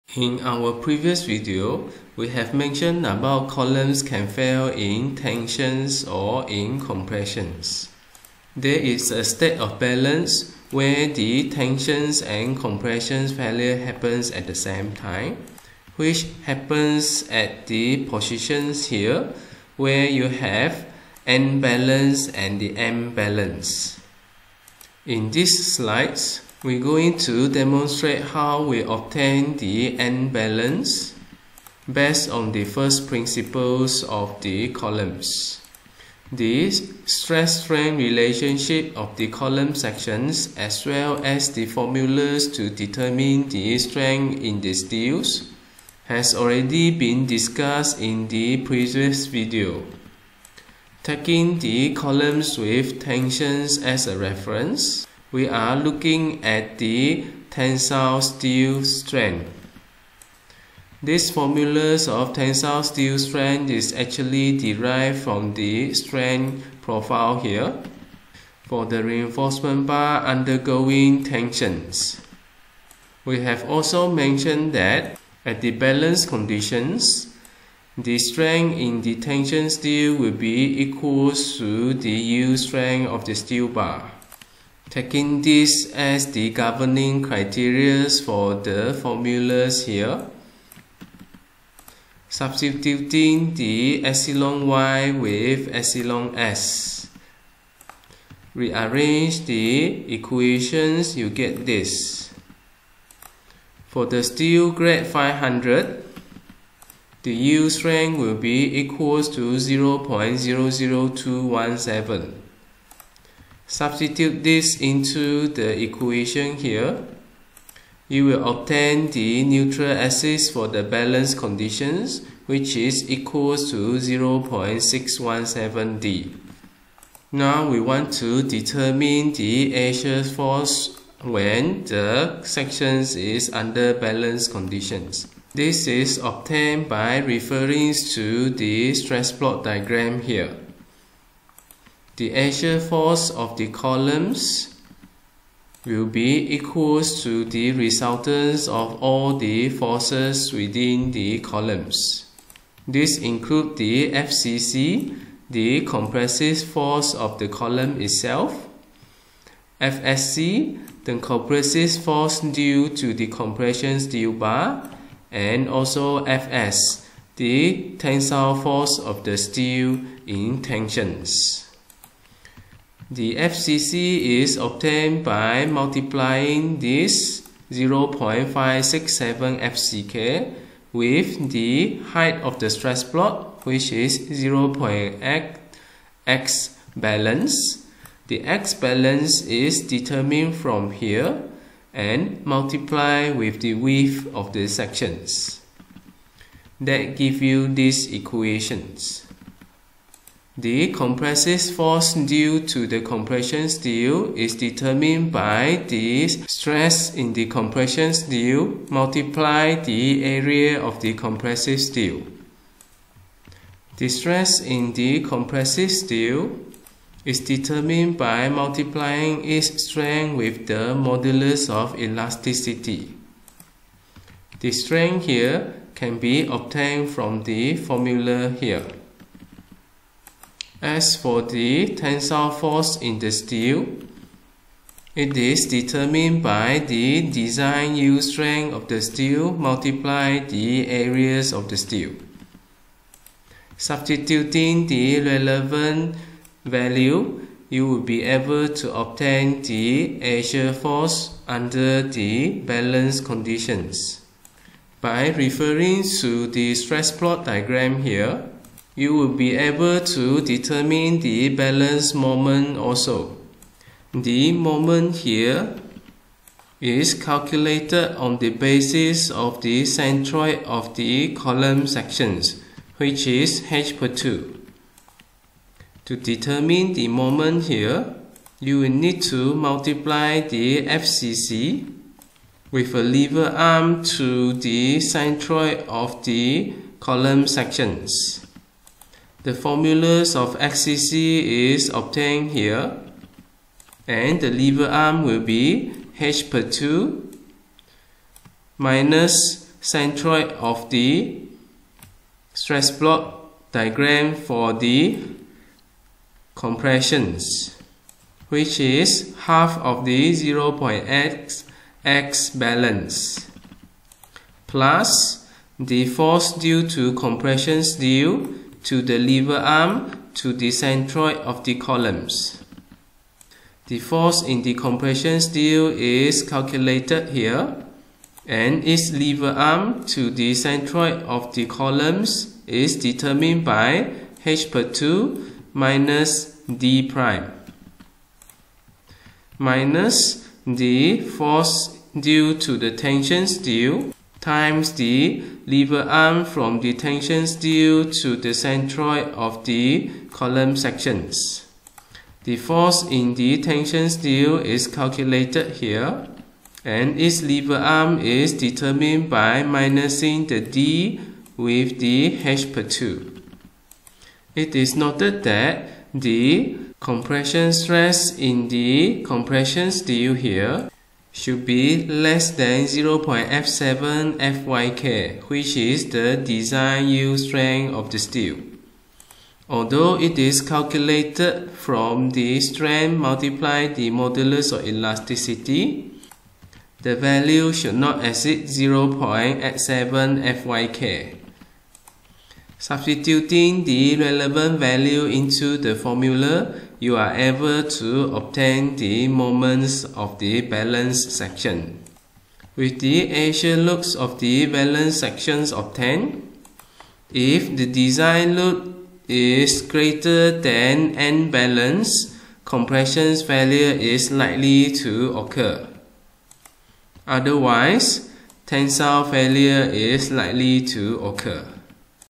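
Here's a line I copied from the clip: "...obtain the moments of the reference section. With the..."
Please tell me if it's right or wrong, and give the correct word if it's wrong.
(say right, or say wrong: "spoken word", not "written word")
wrong: "balance", not "reference".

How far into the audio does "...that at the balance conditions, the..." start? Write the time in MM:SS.
01:14.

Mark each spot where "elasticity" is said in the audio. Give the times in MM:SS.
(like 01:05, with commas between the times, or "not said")
03:41, 06:24.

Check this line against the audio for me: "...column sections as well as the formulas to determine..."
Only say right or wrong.
right.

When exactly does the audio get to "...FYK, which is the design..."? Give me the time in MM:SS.
06:14.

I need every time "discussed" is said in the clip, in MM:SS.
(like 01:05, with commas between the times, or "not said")
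00:47.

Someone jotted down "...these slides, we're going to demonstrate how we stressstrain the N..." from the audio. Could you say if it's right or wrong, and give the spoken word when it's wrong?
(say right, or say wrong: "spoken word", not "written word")
wrong: "obtain", not "stressstrain".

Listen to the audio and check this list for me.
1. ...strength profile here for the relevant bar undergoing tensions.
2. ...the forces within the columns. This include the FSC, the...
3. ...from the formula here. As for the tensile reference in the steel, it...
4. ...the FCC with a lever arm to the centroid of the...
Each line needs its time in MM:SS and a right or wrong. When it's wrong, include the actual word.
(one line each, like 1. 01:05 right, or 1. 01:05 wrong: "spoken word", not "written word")
1. 01:05 wrong: "reinforcement", not "relevant"
2. 02:29 wrong: "FCC", not "FSC"
3. 03:47 wrong: "force", not "reference"
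4. 04:40 right.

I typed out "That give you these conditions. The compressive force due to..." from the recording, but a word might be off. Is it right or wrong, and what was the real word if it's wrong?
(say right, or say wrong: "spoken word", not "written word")
wrong: "equations", not "conditions".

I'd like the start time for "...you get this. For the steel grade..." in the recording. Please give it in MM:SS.
01:41.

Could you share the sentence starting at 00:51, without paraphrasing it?
Taking the columns with tensions as a reference, we are looking at the tensile steel strength.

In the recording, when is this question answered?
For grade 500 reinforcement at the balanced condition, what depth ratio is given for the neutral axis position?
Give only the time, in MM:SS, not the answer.
02:03.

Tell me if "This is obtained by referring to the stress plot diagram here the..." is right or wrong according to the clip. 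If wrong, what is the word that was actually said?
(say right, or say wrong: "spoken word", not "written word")
right.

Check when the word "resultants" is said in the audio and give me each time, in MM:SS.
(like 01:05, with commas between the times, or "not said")
02:27.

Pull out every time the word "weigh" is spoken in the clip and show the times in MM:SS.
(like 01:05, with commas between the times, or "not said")
not said.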